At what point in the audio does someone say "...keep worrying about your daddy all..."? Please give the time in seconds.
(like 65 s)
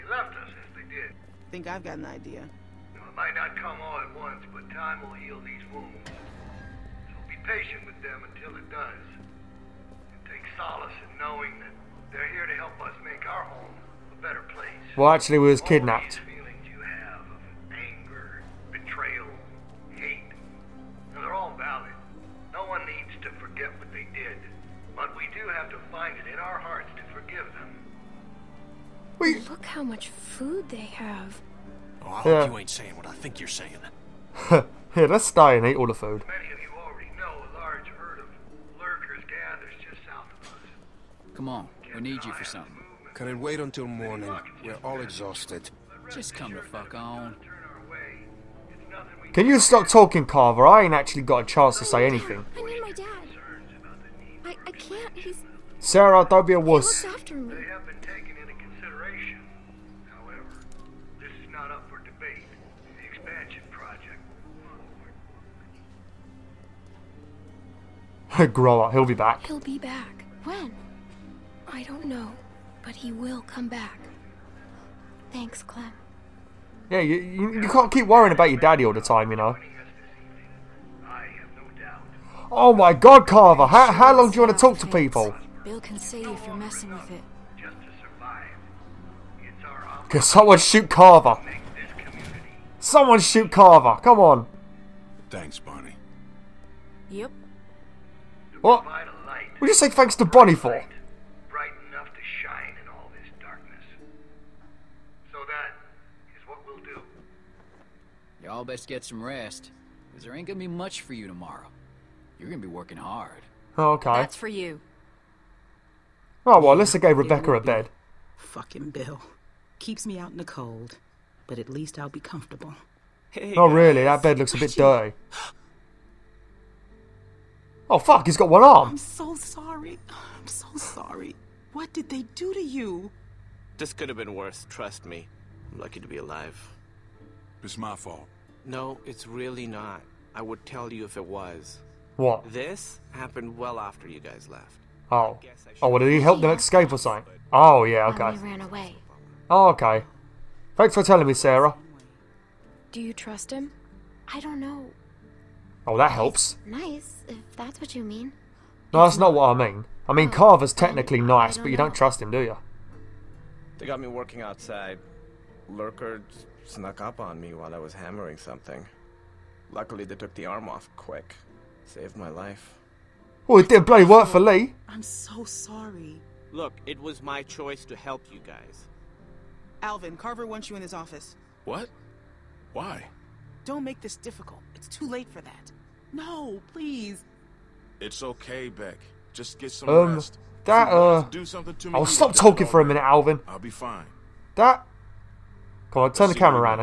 77 s.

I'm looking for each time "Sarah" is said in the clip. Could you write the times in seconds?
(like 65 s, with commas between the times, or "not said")
55 s, 151 s.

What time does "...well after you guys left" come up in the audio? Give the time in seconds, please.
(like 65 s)
143 s.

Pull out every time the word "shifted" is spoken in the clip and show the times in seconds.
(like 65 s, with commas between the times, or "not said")
not said.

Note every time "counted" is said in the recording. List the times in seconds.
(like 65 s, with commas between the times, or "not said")
not said.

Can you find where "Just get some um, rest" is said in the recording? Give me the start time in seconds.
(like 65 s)
189 s.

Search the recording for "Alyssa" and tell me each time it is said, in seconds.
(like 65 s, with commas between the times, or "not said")
116 s.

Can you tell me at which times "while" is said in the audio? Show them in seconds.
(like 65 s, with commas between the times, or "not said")
167 s.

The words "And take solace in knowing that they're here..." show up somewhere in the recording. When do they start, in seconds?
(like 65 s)
9 s.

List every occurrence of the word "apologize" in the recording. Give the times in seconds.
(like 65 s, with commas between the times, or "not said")
not said.